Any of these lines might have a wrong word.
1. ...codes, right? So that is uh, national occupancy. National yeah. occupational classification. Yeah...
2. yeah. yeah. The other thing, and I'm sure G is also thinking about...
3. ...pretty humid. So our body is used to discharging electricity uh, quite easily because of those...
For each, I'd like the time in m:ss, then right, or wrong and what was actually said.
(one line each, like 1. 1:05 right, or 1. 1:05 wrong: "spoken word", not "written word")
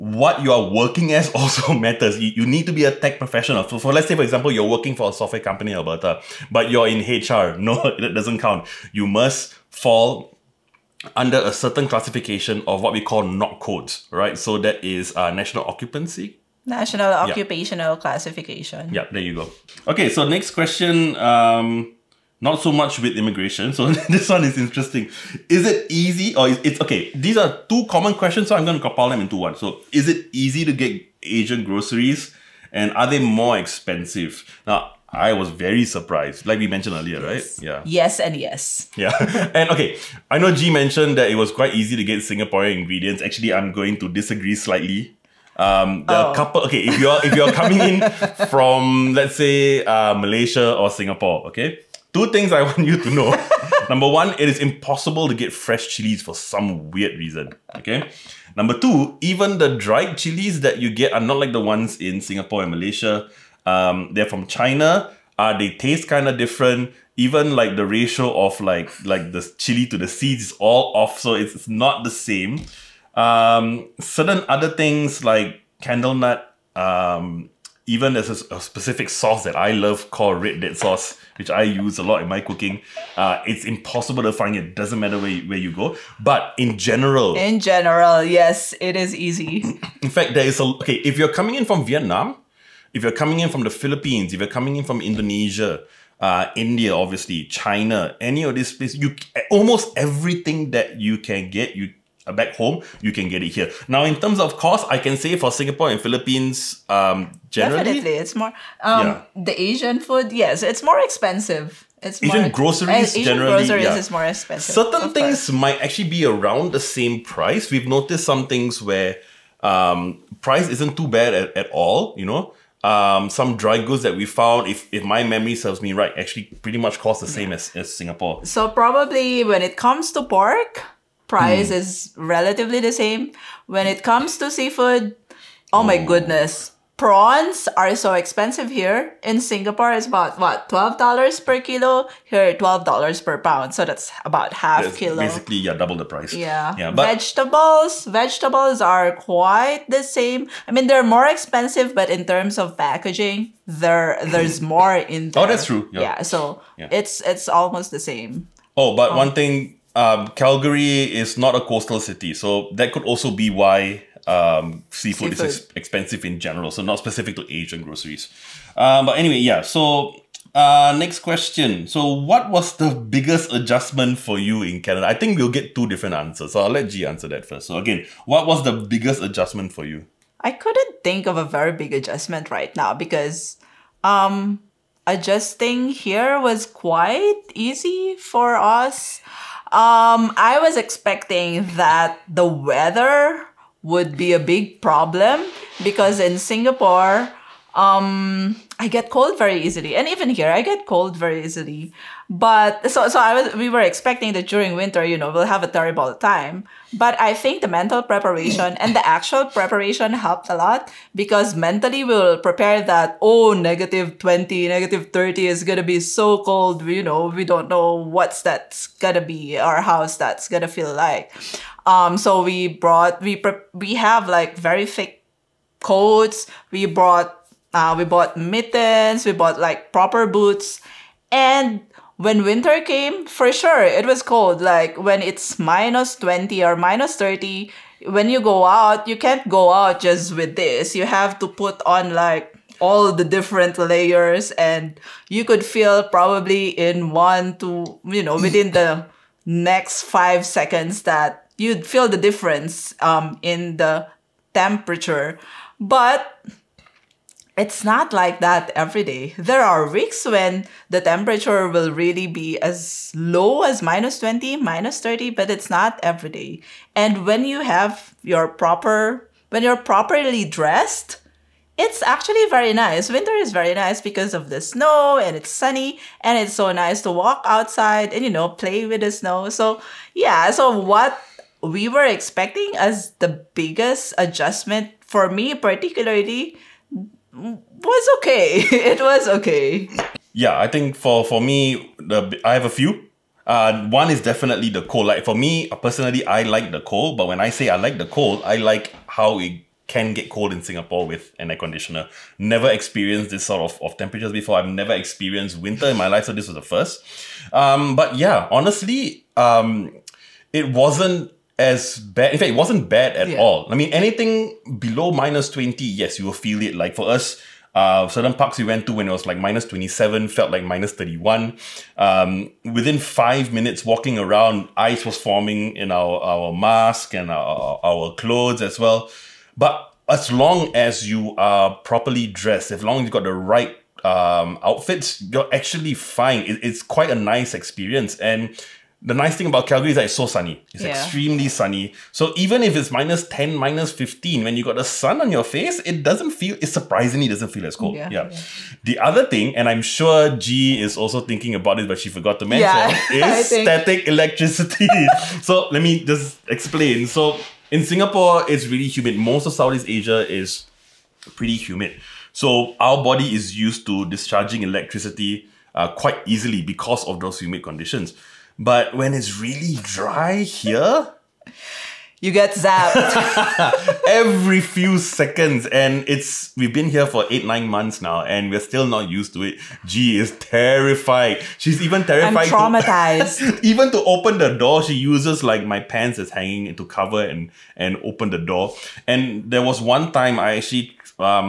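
1. 0:13 right
2. 5:48 right
3. 6:01 right.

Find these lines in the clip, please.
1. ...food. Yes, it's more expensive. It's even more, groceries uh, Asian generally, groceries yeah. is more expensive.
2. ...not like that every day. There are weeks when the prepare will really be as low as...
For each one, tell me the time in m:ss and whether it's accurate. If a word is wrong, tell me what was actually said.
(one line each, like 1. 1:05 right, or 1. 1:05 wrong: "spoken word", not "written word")
1. 1:50 right
2. 4:17 wrong: "temperature", not "prepare".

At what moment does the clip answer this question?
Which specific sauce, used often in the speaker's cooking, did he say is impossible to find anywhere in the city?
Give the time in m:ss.
1:20.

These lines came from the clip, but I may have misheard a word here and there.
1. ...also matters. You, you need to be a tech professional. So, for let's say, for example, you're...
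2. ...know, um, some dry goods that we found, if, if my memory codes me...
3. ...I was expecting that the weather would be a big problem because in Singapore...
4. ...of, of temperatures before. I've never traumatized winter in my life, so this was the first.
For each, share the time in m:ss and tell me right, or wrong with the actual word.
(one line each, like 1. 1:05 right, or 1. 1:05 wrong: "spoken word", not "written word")
1. 0:01 right
2. 2:02 wrong: "serves", not "codes"
3. 3:10 right
4. 5:03 wrong: "experienced", not "traumatized".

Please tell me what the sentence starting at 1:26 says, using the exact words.
But in general, in general, yes, it is easy.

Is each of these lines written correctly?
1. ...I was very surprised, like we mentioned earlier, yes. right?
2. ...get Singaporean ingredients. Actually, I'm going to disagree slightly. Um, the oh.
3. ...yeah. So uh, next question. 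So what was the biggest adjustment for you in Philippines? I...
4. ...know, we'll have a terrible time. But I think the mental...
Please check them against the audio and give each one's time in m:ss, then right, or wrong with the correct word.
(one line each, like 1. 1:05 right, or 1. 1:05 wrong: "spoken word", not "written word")
1. 0:35 right
2. 0:42 right
3. 2:49 wrong: "Canada", not "Philippines"
4. 3:25 right.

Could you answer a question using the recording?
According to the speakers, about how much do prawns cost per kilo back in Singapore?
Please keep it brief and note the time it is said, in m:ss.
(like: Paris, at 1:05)
$12, at 2:20.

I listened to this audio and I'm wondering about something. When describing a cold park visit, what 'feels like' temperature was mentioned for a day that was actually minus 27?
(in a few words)
-31.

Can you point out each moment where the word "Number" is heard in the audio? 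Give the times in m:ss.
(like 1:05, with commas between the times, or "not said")
0:53, 0:58.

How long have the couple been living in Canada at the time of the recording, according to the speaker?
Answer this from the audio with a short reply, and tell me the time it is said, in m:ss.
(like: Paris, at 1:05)
8-9 months, at 6:17.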